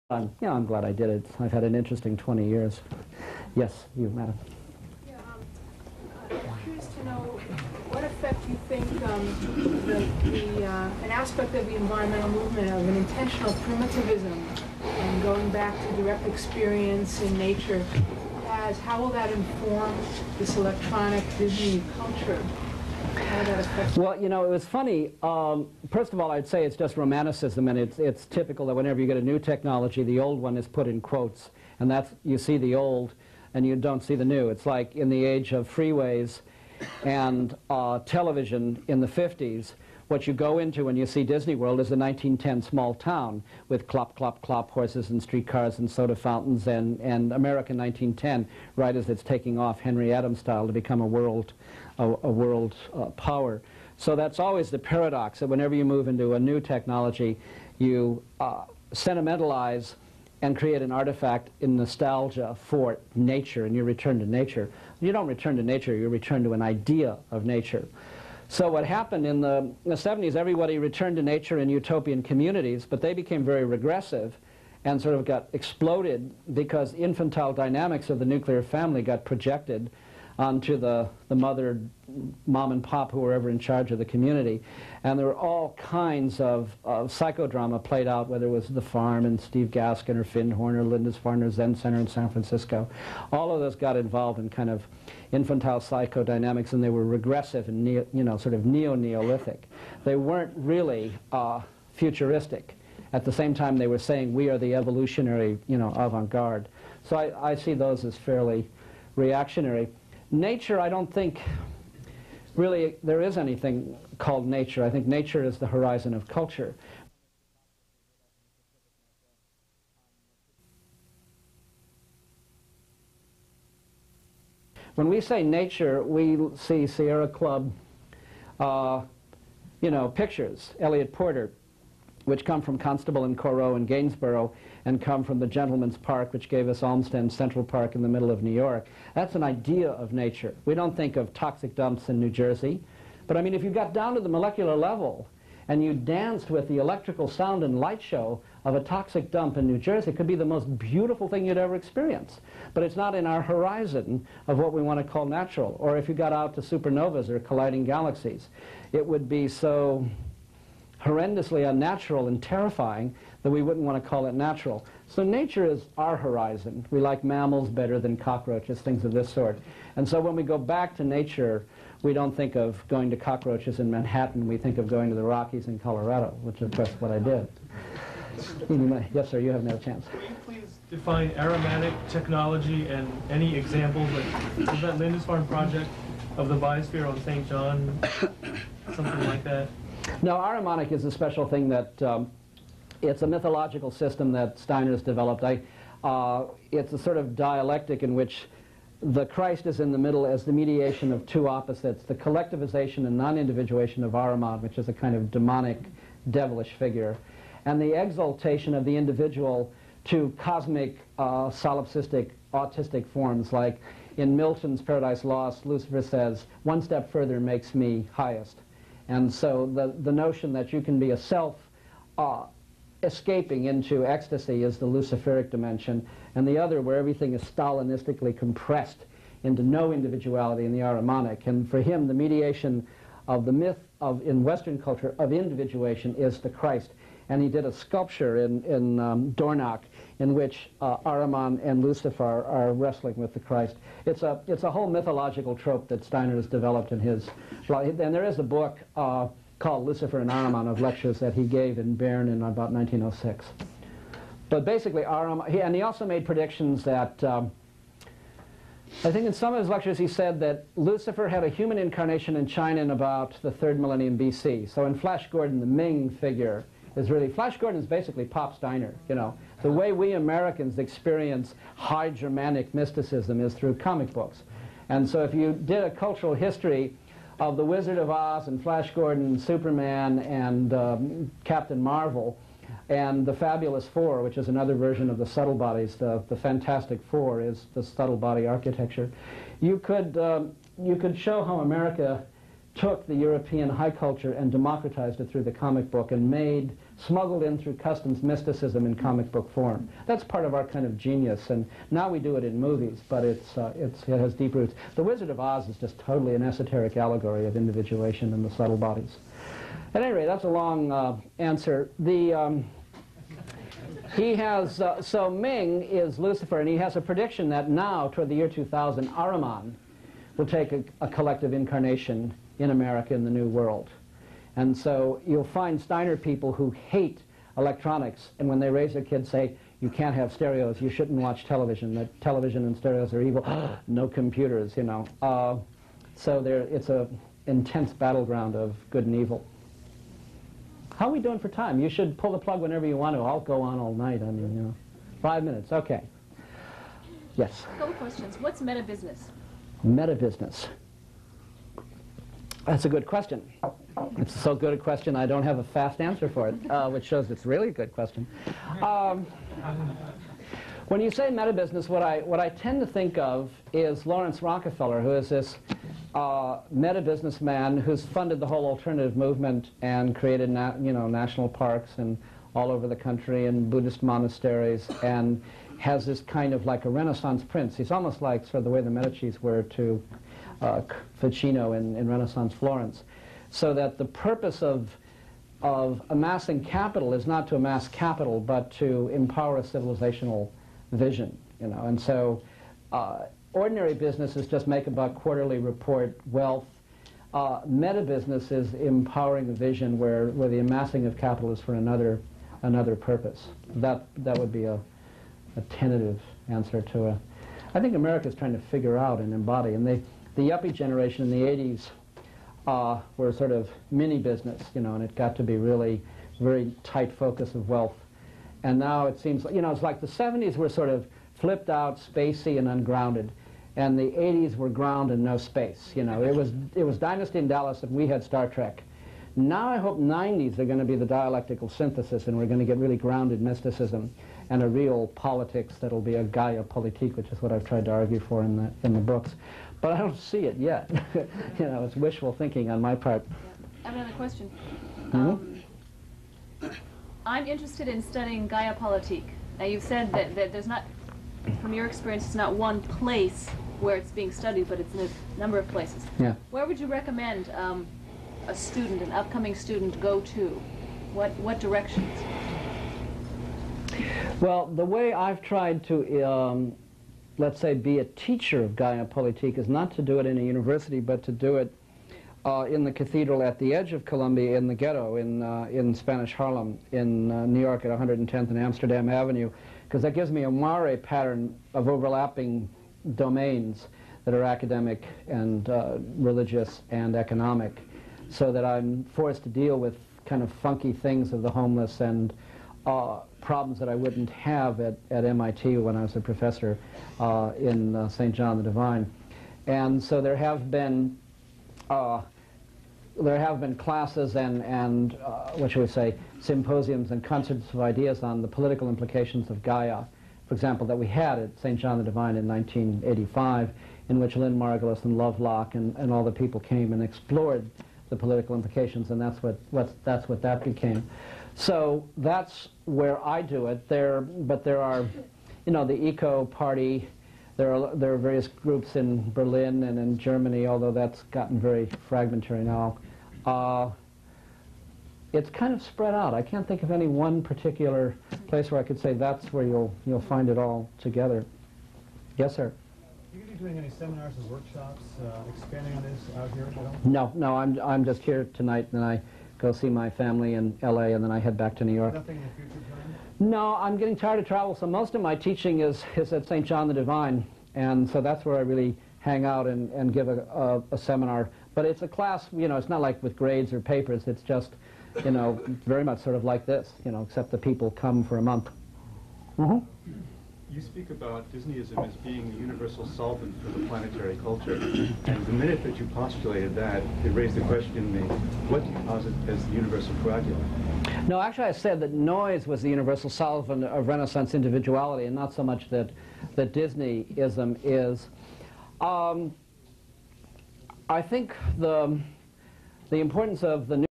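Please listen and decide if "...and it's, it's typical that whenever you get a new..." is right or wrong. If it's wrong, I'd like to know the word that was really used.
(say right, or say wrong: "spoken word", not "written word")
right.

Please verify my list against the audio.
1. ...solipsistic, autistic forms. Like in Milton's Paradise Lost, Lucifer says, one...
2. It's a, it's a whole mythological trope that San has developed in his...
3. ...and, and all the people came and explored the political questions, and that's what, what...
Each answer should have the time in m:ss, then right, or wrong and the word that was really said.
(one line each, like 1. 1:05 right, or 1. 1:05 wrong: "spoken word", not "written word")
1. 3:31 right
2. 4:04 wrong: "Steiner", not "San"
3. 8:35 wrong: "implications", not "questions".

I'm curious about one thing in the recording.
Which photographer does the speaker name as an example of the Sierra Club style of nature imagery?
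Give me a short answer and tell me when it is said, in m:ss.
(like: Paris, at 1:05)
Eliot Porter, at 2:10.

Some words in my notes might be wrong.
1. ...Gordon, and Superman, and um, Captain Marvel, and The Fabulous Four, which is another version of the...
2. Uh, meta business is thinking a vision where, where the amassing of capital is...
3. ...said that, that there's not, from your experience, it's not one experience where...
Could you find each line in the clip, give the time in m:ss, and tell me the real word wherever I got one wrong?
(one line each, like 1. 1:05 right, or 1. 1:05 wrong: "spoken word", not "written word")
1. 4:38 right
2. 6:37 wrong: "empowering", not "thinking"
3. 7:29 wrong: "place", not "experience".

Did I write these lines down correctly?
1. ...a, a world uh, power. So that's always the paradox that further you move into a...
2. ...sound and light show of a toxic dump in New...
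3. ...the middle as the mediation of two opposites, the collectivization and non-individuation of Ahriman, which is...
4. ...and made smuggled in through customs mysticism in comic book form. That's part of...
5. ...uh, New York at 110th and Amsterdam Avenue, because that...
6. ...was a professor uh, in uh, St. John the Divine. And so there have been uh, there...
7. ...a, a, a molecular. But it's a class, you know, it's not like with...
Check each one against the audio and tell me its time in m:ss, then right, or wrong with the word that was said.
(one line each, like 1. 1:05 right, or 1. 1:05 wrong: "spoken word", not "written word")
1. 0:51 wrong: "whenever", not "further"
2. 2:27 right
3. 3:19 right
4. 4:56 right
5. 7:57 right
6. 8:16 right
7. 9:20 wrong: "seminar", not "molecular".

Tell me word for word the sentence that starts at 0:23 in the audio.
Well, you know, it was funny.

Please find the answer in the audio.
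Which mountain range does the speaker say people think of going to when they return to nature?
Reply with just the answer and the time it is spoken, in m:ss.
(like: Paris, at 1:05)
the Rockies, at 2:55.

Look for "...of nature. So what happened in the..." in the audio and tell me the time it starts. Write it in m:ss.
1:07.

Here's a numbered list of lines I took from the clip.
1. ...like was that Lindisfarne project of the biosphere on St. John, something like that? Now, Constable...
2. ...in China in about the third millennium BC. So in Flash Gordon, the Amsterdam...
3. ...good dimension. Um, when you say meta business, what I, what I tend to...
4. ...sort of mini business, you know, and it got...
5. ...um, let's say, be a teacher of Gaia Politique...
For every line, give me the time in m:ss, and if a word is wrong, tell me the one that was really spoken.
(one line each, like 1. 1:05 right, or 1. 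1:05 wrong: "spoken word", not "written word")
1. 3:04 wrong: "Ahrimanic", not "Constable"
2. 4:22 wrong: "Ming", not "Amsterdam"
3. 5:57 wrong: "question", not "dimension"
4. 6:53 right
5. 7:46 right.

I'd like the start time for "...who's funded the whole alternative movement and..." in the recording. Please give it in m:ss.
6:07.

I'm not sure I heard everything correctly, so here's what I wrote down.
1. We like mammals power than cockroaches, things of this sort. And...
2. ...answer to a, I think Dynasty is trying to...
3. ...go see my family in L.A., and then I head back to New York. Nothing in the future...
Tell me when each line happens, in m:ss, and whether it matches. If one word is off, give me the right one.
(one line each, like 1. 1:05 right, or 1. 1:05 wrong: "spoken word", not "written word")
1. 2:46 wrong: "better", not "power"
2. 6:46 wrong: "America", not "Dynasty"
3. 9:09 right.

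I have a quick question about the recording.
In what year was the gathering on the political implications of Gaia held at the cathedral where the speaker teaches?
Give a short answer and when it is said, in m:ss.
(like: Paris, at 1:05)
1985, at 8:32.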